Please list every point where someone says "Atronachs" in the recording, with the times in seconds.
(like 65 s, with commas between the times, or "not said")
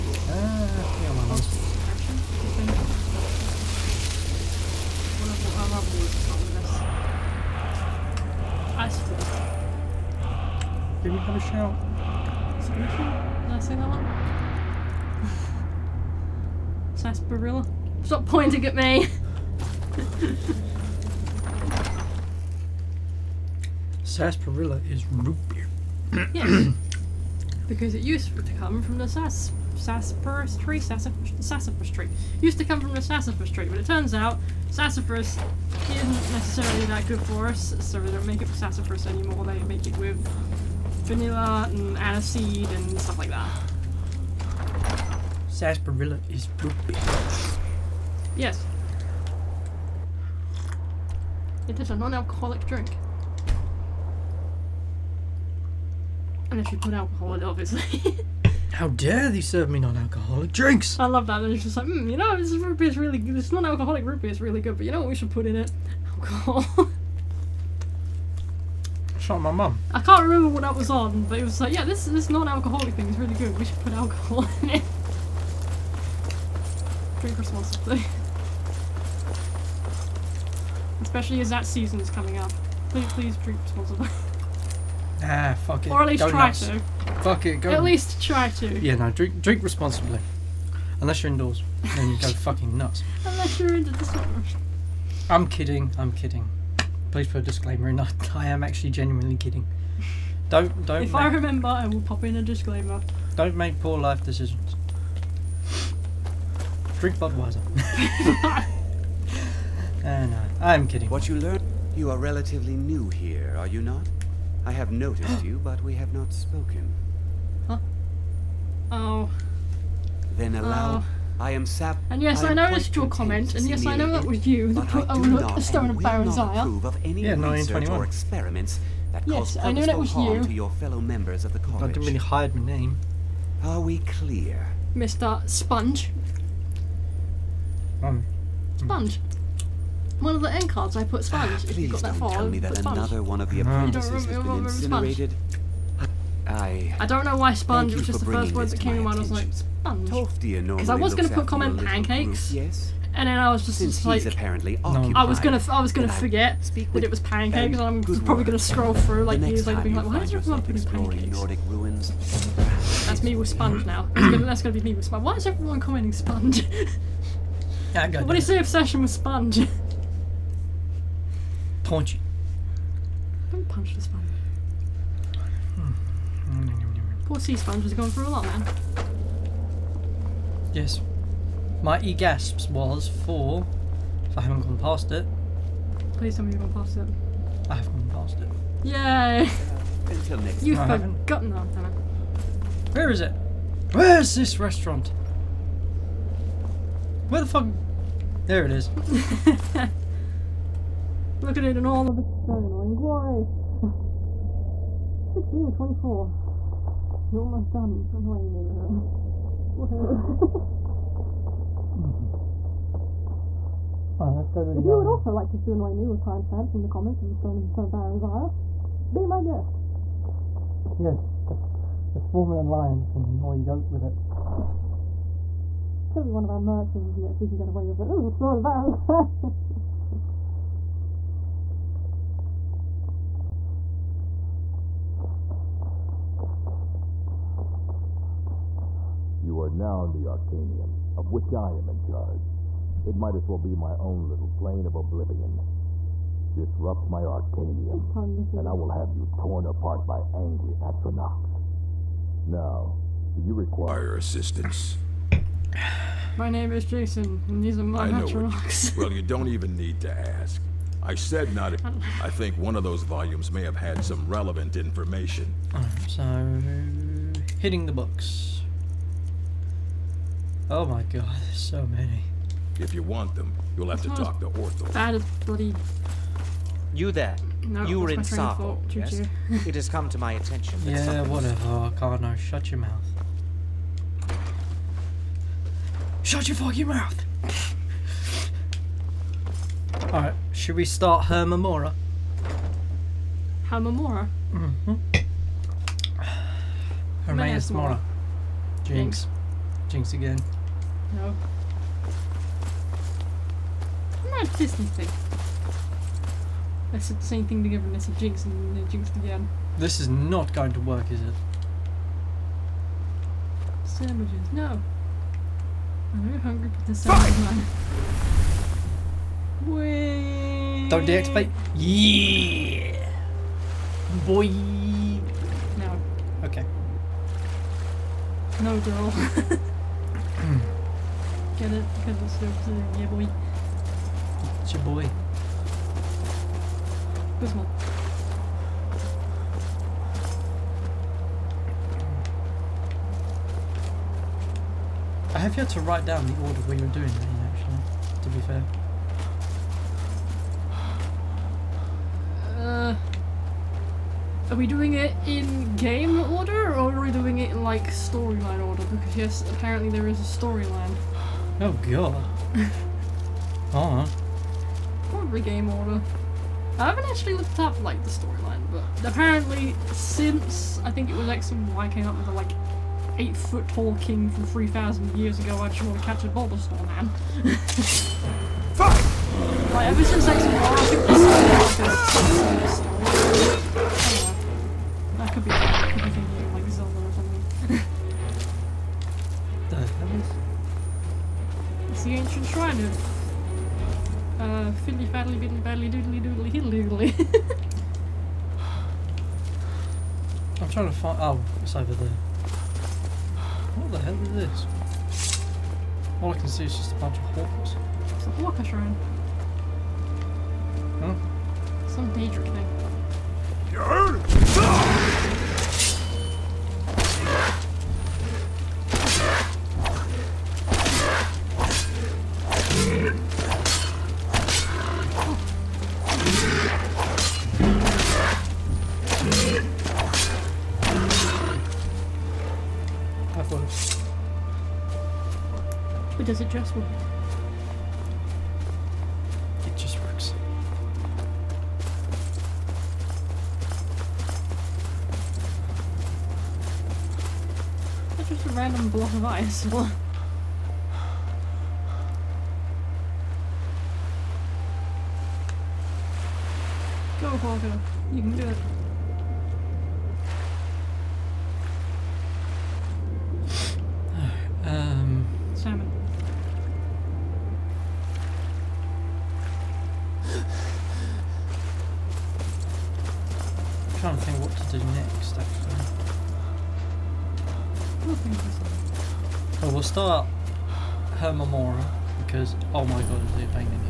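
250 s, 258 s.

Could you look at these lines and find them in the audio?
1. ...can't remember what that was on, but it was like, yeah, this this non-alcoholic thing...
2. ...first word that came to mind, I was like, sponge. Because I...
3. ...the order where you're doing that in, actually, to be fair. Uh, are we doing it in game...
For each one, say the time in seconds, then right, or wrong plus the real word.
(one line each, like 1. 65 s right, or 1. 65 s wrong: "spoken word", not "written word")
1. 70 s right
2. 148 s right
3. 346 s right.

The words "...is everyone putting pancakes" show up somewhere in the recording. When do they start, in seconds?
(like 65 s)
160 s.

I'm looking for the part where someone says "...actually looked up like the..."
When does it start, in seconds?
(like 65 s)
367 s.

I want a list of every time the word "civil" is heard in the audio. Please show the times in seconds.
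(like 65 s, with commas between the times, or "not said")
not said.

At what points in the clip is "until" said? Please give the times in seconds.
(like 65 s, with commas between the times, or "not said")
190 s.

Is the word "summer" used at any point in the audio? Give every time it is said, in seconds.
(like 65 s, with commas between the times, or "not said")
94 s.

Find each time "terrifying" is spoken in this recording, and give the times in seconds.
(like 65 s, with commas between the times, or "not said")
not said.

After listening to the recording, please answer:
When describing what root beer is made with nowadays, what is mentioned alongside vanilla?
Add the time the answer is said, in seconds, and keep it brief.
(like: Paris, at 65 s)
Aniseed, at 41 s.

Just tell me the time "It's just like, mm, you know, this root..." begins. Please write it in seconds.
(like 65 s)
61 s.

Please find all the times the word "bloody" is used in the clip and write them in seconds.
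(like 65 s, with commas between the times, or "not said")
275 s.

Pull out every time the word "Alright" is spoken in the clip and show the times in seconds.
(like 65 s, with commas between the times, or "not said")
214 s, 290 s, 362 s.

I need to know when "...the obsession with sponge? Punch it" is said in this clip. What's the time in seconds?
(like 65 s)
168 s.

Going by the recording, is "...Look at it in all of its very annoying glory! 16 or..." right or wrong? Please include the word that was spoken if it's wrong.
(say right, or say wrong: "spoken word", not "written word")
right.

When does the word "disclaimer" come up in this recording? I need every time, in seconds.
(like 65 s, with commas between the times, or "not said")
97 s, 102 s.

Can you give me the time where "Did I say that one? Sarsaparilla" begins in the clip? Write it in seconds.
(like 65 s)
12 s.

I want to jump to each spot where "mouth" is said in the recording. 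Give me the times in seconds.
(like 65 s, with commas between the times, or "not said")
282 s, 286 s.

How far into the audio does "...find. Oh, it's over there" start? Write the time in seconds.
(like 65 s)
400 s.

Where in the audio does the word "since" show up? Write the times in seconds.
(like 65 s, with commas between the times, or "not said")
153 s, 369 s, 380 s.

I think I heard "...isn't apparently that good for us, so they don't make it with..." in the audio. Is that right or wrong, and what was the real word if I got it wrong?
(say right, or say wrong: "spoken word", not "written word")
wrong: "necessarily", not "apparently".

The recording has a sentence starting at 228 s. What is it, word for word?
This is the Stone of Baron's Isle!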